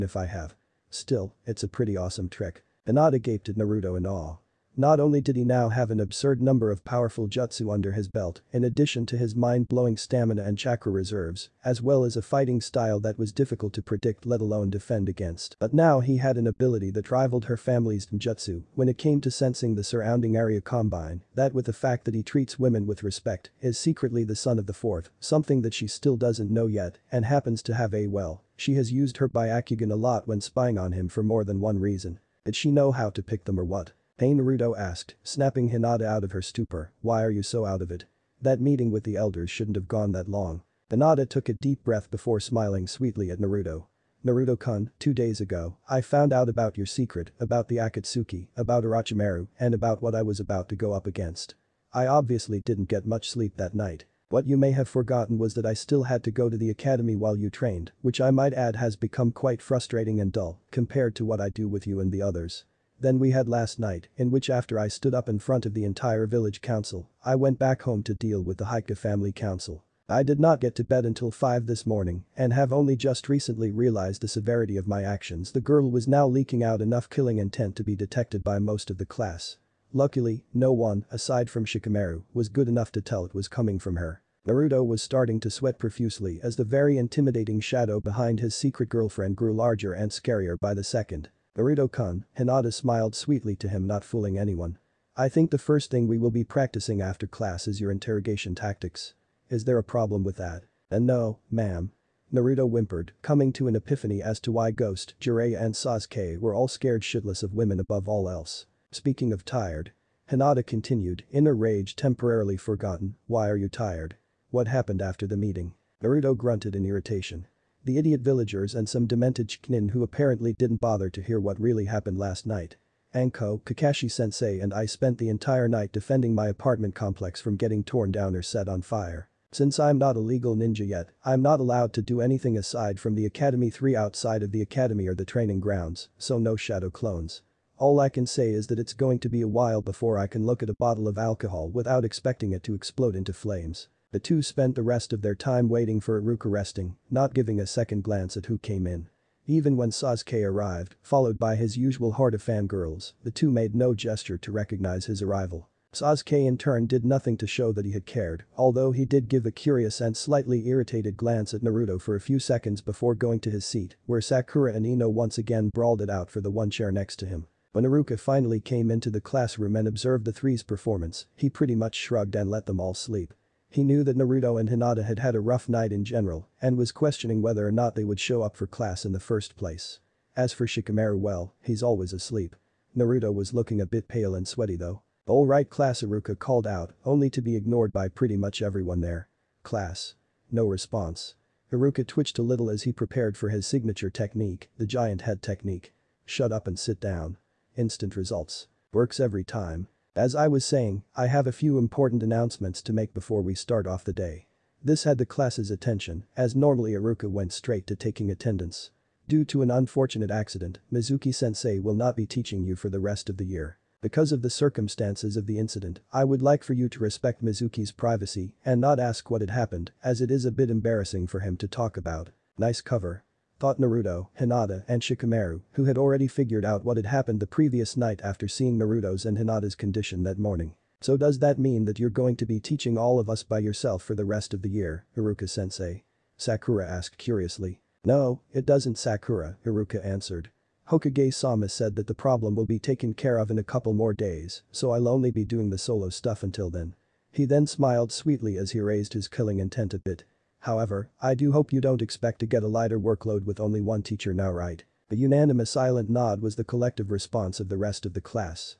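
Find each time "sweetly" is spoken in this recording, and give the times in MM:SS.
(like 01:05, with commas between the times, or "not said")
00:42, 01:33, 04:08.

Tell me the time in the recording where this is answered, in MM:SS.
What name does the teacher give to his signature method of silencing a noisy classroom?
03:14.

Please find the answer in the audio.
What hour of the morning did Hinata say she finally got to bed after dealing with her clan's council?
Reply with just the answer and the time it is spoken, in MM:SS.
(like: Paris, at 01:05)
5, at 01:11.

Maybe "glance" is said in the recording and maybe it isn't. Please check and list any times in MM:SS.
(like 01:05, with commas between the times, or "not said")
02:28, 02:41.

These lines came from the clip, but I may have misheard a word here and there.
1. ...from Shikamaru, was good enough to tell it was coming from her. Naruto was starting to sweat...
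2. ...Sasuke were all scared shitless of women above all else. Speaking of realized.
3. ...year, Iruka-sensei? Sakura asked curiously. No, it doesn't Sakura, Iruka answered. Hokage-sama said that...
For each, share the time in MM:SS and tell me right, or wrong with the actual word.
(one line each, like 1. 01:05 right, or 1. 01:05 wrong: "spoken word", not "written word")
1. 01:21 right
2. 01:45 wrong: "tired", not "realized"
3. 03:54 right.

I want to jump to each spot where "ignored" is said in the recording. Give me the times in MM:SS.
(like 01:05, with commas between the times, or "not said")
03:07.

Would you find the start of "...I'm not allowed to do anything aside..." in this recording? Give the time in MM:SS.
02:11.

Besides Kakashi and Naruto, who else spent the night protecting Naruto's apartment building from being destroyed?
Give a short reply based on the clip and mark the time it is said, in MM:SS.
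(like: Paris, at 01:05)
Anko, at 02:03.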